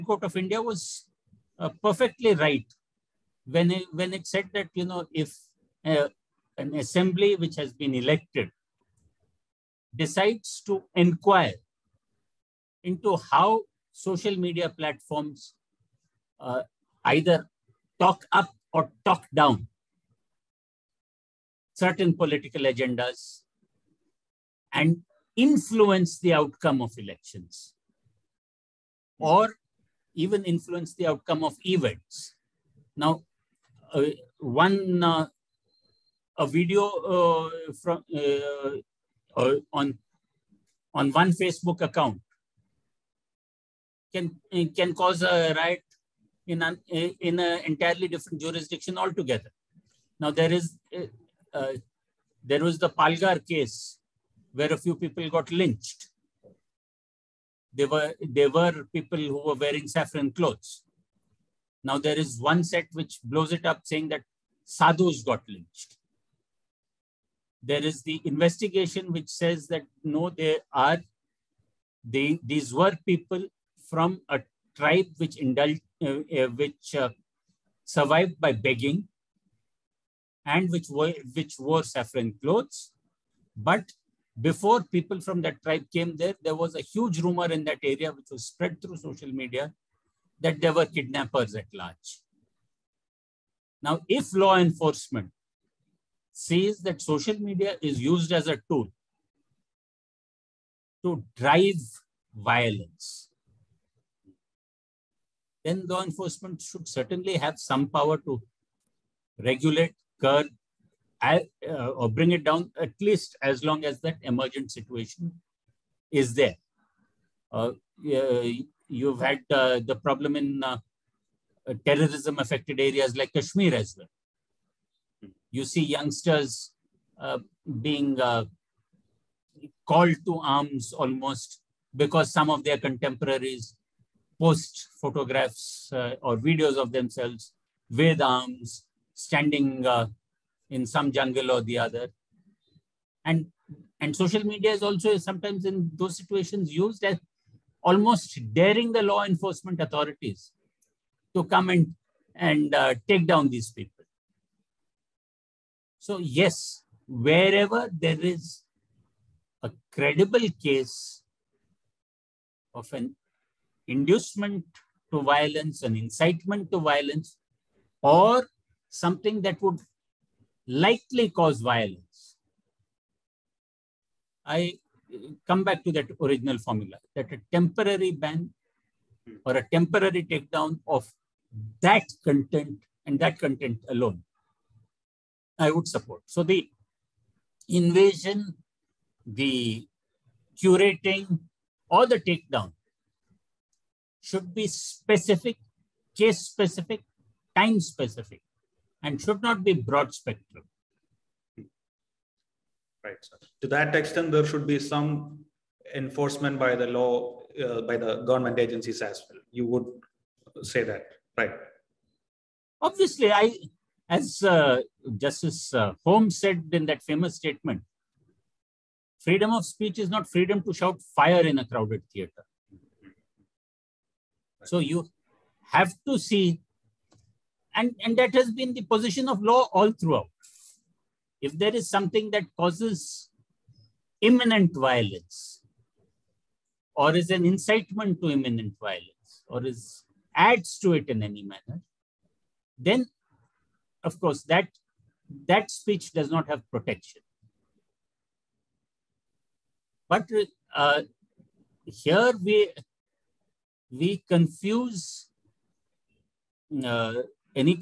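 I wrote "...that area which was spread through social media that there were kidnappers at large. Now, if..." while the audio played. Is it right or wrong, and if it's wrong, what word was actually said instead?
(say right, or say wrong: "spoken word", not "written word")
right.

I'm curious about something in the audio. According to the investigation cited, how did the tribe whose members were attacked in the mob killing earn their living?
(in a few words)
Begging.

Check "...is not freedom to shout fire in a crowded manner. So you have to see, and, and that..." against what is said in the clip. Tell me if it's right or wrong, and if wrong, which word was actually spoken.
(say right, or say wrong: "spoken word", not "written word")
wrong: "theater", not "manner".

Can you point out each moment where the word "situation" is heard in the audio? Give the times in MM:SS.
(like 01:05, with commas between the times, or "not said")
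01:54, 02:26.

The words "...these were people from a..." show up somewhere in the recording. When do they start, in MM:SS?
01:12.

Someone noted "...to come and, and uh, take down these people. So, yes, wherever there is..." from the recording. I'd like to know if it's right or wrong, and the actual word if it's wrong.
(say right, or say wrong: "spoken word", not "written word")
right.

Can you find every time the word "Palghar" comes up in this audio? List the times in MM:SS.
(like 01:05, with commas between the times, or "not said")
00:52.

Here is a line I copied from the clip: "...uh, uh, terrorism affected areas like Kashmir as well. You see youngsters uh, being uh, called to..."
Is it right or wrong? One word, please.
right.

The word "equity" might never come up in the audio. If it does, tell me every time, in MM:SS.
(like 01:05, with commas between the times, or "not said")
not said.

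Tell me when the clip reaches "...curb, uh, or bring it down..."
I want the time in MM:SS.
01:50.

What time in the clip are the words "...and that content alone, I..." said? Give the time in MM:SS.
03:03.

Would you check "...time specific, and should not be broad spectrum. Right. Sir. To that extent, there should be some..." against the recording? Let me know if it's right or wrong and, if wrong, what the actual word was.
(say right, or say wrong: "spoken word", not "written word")
right.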